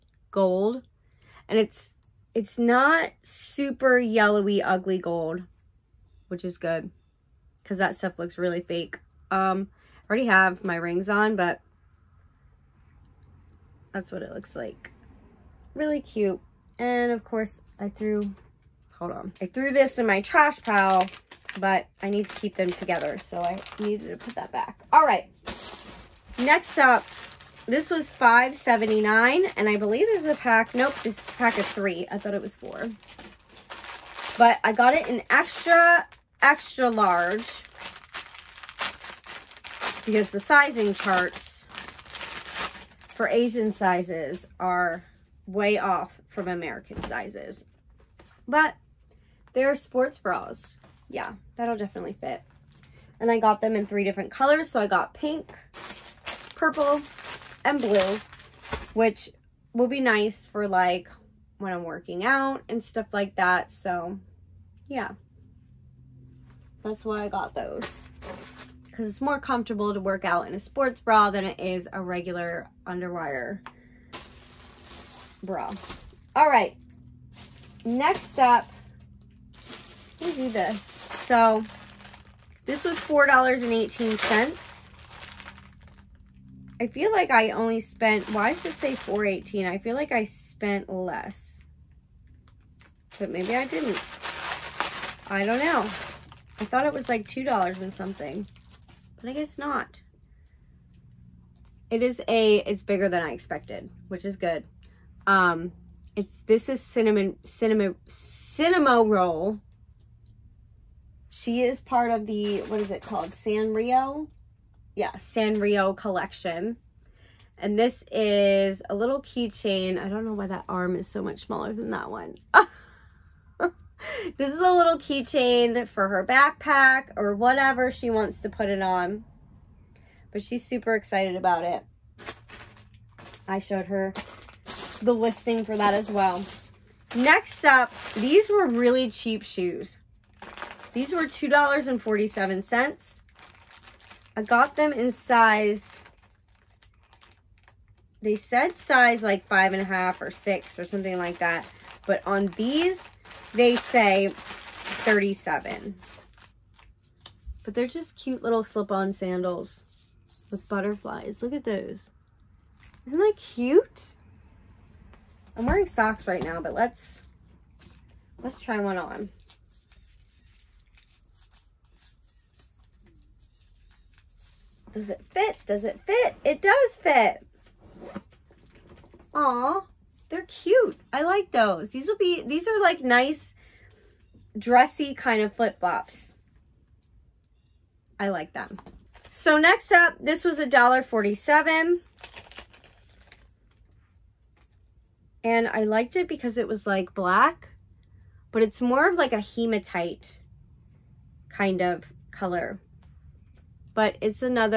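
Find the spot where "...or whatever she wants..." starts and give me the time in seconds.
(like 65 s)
127 s.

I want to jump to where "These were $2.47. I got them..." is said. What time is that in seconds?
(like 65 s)
140 s.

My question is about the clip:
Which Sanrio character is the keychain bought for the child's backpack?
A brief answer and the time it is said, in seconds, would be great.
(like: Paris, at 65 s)
Cinnamoroll, at 108 s.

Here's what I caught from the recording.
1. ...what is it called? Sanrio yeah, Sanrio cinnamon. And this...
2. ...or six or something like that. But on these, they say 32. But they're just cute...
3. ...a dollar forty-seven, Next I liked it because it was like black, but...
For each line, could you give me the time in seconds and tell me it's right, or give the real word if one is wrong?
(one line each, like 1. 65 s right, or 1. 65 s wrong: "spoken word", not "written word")
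1. 112 s wrong: "collection", not "cinnamon"
2. 150 s wrong: "37", not "32"
3. 190 s wrong: "And", not "Next".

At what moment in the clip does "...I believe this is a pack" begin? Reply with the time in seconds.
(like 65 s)
29 s.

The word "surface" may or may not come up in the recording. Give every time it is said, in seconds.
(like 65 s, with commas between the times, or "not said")
not said.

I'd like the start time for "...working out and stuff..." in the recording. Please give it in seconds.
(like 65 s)
61 s.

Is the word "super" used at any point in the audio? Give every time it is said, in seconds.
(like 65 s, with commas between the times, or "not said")
3 s, 130 s.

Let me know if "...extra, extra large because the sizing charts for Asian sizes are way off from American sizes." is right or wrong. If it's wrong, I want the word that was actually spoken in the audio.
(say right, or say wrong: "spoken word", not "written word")
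right.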